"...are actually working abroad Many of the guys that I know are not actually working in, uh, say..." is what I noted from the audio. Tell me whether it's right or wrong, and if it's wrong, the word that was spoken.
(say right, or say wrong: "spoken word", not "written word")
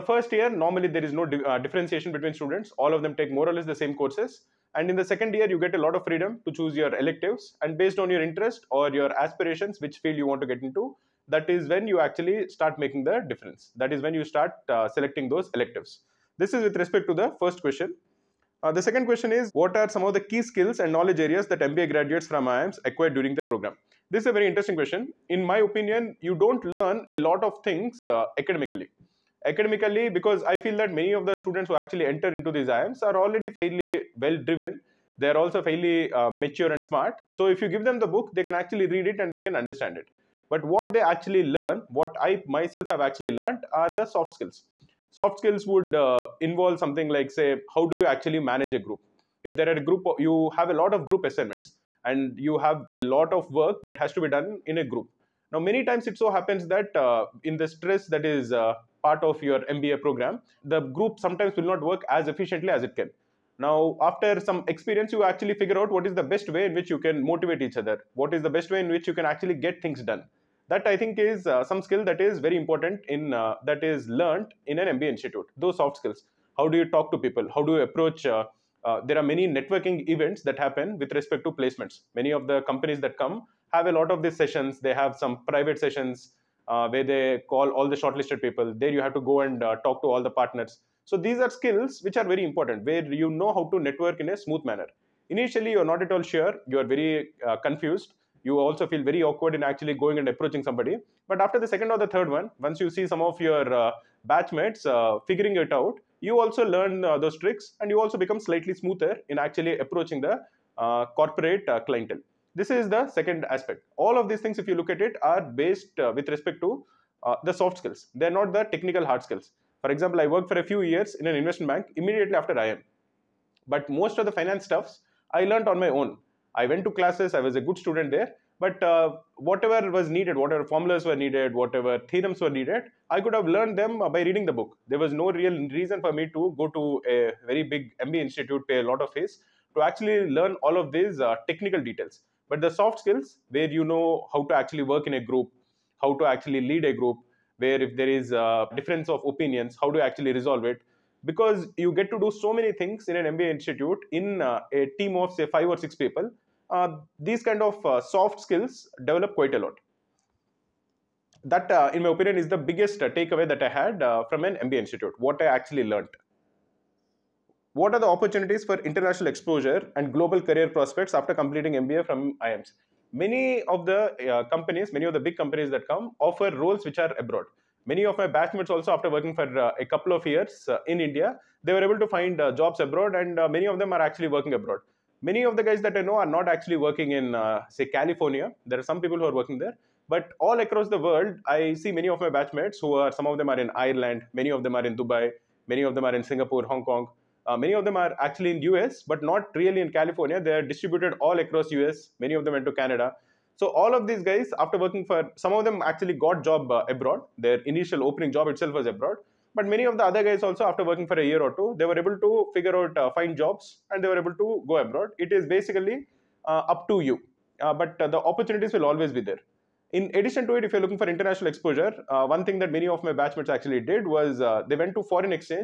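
right.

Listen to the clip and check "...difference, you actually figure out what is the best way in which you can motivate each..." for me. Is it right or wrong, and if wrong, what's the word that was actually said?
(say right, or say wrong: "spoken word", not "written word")
wrong: "experience", not "difference".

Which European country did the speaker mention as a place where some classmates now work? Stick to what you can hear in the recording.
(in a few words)
Ireland.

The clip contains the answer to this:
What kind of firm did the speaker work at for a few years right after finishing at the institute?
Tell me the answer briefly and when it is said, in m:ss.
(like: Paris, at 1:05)
Investment bank, at 2:01.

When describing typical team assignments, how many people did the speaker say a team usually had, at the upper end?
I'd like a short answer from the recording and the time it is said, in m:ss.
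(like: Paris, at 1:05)
6, at 2:35.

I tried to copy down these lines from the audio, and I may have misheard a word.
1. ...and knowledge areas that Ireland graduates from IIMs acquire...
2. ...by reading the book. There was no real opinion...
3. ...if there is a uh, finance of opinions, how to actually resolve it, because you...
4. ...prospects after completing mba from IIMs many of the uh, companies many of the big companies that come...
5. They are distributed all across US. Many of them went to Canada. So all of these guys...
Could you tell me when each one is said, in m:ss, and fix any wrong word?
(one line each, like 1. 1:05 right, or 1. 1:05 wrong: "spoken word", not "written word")
1. 0:20 wrong: "MBA", not "Ireland"
2. 2:14 wrong: "reason", not "opinion"
3. 2:27 wrong: "difference", not "finance"
4. 2:50 right
5. 3:20 right.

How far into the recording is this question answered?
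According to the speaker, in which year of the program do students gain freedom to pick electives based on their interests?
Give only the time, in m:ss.
0:05.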